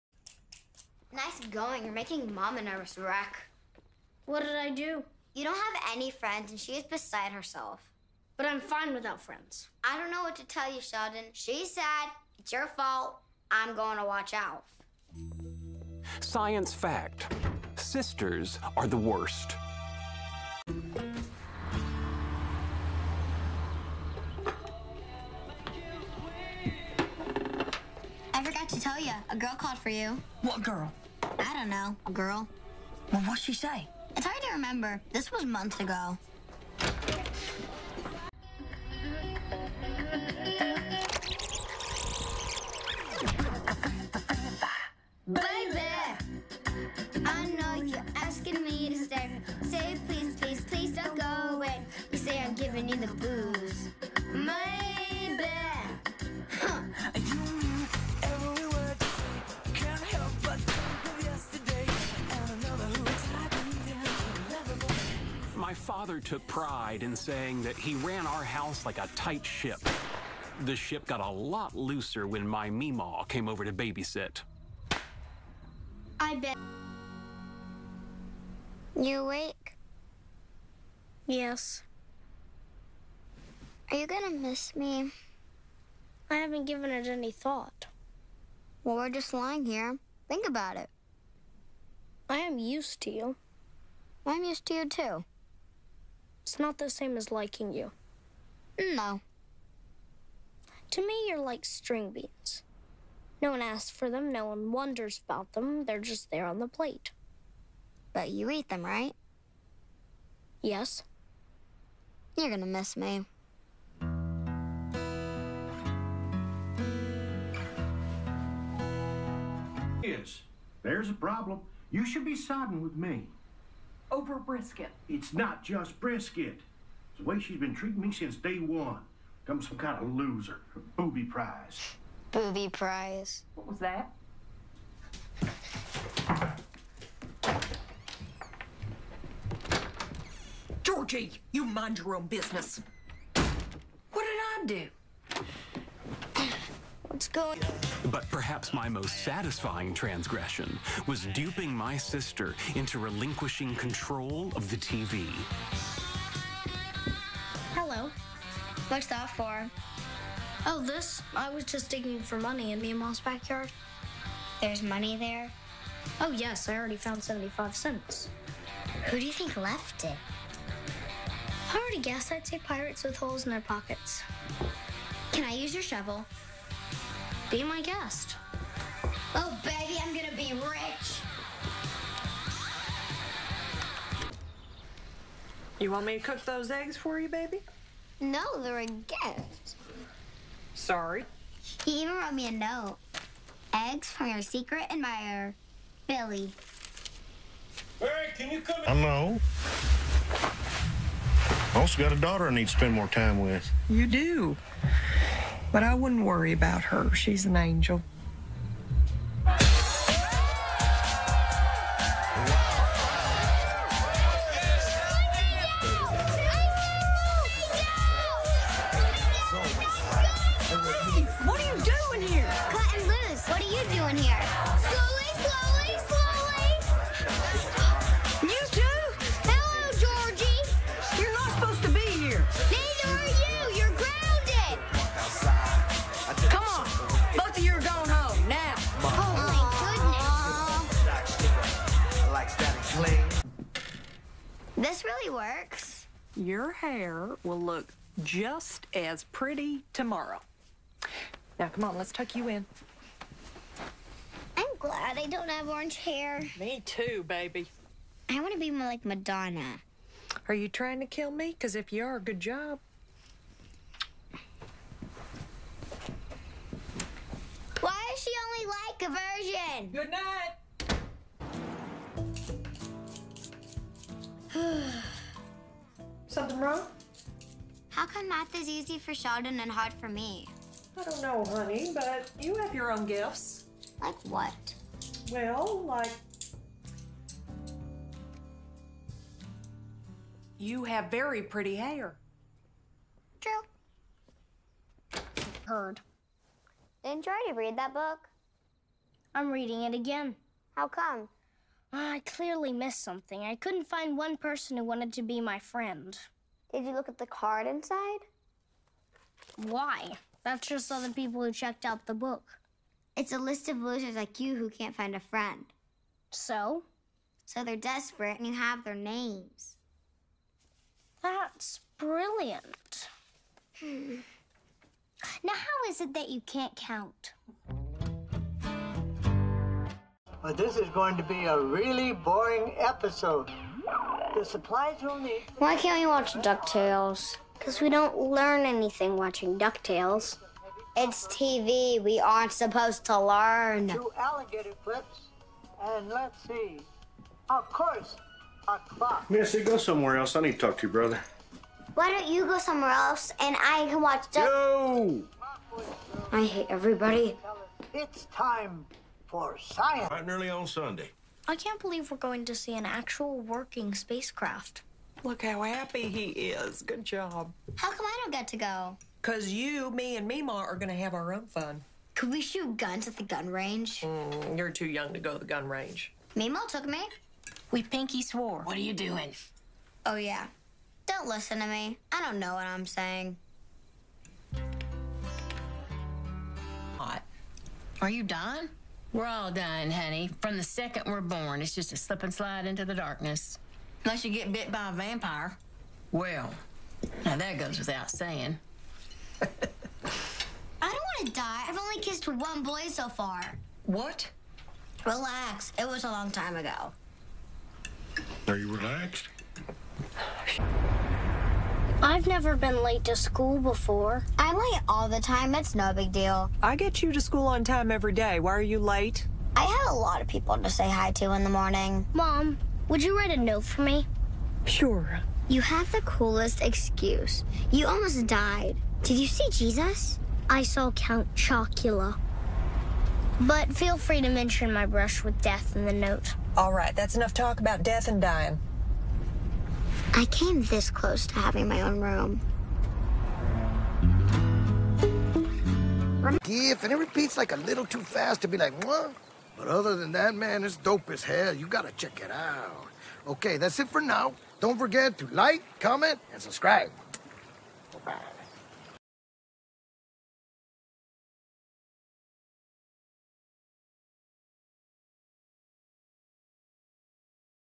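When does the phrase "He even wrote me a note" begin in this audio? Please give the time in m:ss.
3:11.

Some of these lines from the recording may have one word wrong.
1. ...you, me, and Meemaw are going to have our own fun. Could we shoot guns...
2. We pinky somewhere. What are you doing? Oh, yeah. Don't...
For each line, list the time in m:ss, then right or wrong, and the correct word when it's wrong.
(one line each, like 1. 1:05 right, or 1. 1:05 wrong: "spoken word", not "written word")
1. 6:09 right
2. 6:17 wrong: "swore", not "somewhere".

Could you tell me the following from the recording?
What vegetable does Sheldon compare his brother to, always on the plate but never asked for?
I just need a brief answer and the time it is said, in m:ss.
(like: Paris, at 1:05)
String beans, at 1:41.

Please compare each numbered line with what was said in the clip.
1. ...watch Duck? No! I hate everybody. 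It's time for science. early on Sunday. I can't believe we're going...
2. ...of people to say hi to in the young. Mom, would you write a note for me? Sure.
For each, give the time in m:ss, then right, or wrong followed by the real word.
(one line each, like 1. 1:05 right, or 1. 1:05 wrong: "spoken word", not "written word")
1. 5:54 right
2. 7:00 wrong: "morning", not "young".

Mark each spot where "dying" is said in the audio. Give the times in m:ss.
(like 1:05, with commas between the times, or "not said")
6:29, 7:18.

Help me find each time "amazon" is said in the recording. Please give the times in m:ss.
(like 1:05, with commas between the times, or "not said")
not said.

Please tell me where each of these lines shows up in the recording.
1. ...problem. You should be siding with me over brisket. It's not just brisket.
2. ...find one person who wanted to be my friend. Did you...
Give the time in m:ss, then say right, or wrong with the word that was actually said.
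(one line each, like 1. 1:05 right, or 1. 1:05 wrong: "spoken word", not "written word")
1. 2:01 right
2. 5:03 right.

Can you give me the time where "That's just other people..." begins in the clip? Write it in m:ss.
5:10.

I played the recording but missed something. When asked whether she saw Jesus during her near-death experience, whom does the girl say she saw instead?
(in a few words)
Count Chocula.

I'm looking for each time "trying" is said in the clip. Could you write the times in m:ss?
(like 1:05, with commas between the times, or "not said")
4:20.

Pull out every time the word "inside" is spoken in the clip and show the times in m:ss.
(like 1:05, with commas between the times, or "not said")
5:07.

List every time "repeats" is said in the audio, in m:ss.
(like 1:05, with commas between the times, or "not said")
7:26.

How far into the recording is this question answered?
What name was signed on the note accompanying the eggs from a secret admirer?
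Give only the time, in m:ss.
3:16.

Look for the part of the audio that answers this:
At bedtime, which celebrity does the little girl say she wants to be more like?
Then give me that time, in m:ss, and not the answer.
4:19.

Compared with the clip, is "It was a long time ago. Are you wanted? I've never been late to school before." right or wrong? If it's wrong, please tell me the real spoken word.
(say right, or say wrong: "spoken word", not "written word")
wrong: "relaxed", not "wanted".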